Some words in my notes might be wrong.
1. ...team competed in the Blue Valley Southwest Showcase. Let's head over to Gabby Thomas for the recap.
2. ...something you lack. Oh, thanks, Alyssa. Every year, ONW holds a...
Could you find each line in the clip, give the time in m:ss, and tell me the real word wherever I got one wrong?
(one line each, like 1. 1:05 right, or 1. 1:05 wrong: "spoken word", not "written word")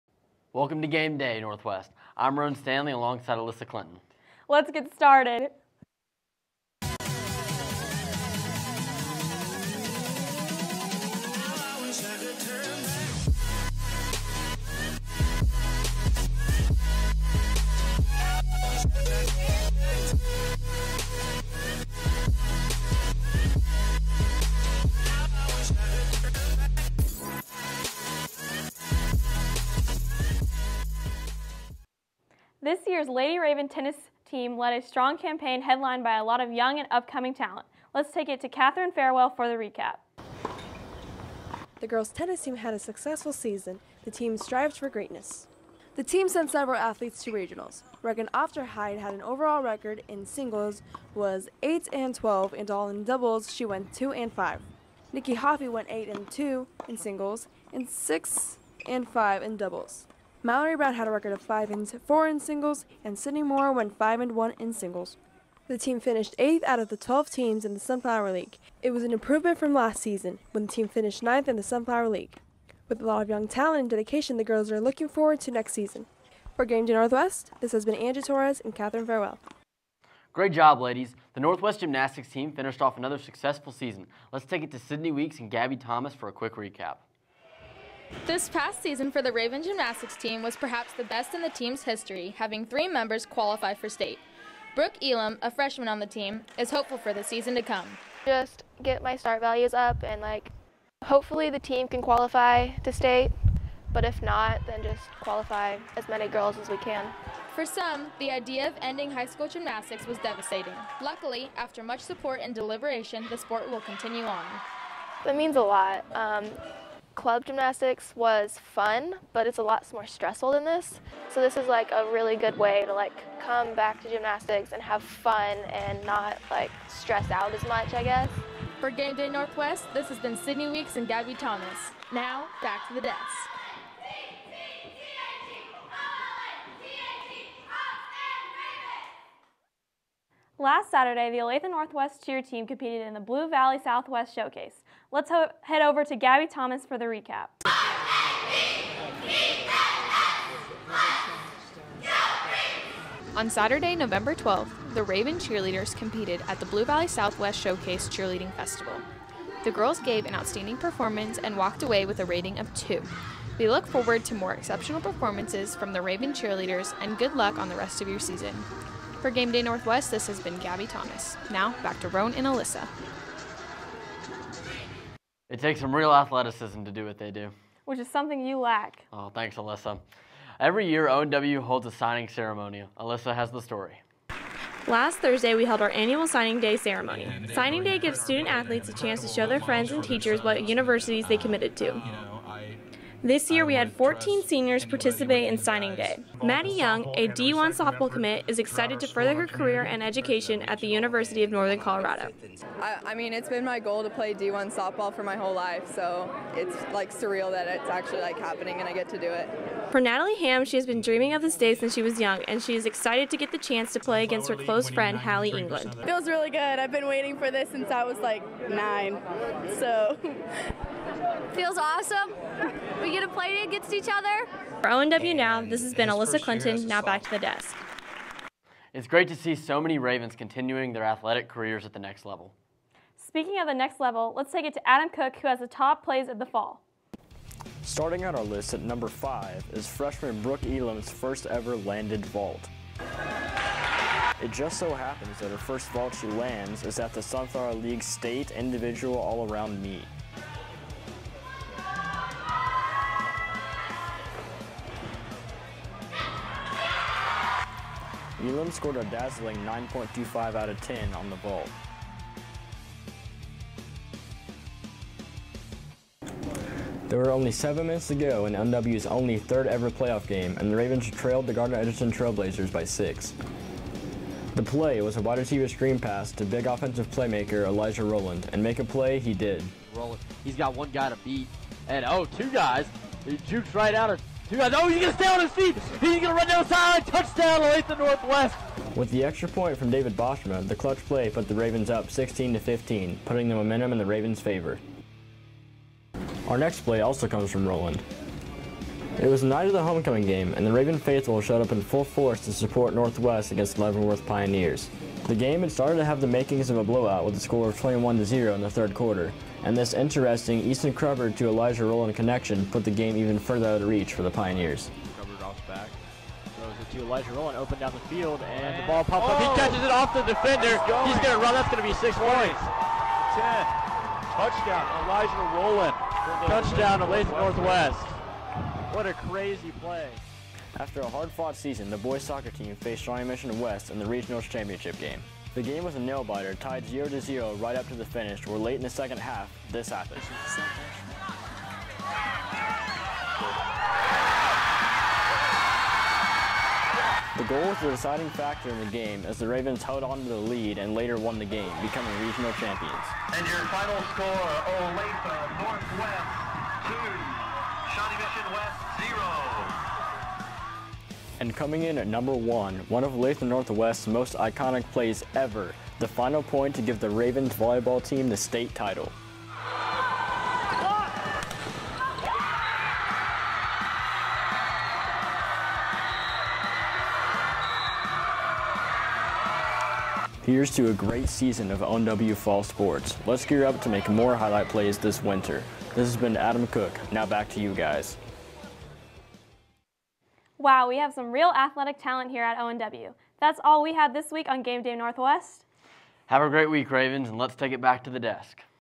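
1. 2:22 right
2. 2:58 right.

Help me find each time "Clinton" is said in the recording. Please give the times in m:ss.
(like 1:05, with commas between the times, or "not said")
0:03, 3:46.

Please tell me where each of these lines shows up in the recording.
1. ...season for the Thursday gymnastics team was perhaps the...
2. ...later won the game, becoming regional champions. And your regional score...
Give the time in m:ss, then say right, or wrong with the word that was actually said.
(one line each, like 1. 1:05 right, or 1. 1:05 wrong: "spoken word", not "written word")
1. 1:28 wrong: "Raven", not "Thursday"
2. 5:50 wrong: "final", not "regional".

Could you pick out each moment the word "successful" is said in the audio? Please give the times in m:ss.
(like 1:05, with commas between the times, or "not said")
0:42, 1:23.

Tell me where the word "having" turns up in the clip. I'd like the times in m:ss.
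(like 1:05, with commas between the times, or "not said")
1:32.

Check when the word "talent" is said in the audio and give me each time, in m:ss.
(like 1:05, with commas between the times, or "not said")
0:37, 1:13, 6:31.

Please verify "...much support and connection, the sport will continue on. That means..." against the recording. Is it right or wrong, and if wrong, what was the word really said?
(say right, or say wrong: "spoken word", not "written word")
wrong: "deliberation", not "connection".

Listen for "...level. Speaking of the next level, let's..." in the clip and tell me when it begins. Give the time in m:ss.
3:52.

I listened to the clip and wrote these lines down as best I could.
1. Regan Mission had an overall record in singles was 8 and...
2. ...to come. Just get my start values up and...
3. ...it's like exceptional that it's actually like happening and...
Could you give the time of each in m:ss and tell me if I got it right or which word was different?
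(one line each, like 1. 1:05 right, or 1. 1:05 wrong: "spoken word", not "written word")
1. 0:48 wrong: "Hyde", not "Mission"
2. 1:37 right
3. 3:26 wrong: "surreal", not "exceptional".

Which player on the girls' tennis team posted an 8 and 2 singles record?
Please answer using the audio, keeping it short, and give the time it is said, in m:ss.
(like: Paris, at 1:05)
Nikki Hoffey, at 0:55.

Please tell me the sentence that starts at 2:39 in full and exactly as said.
The girls gave an outstanding performance and walked away with a rating of 2.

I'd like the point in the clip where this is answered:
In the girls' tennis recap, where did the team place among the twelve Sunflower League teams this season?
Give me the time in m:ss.
1:06.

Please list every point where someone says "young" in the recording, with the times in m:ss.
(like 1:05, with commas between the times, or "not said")
0:36, 1:13, 3:16, 3:32.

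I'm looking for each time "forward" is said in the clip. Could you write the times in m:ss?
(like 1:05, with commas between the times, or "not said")
1:15, 2:43.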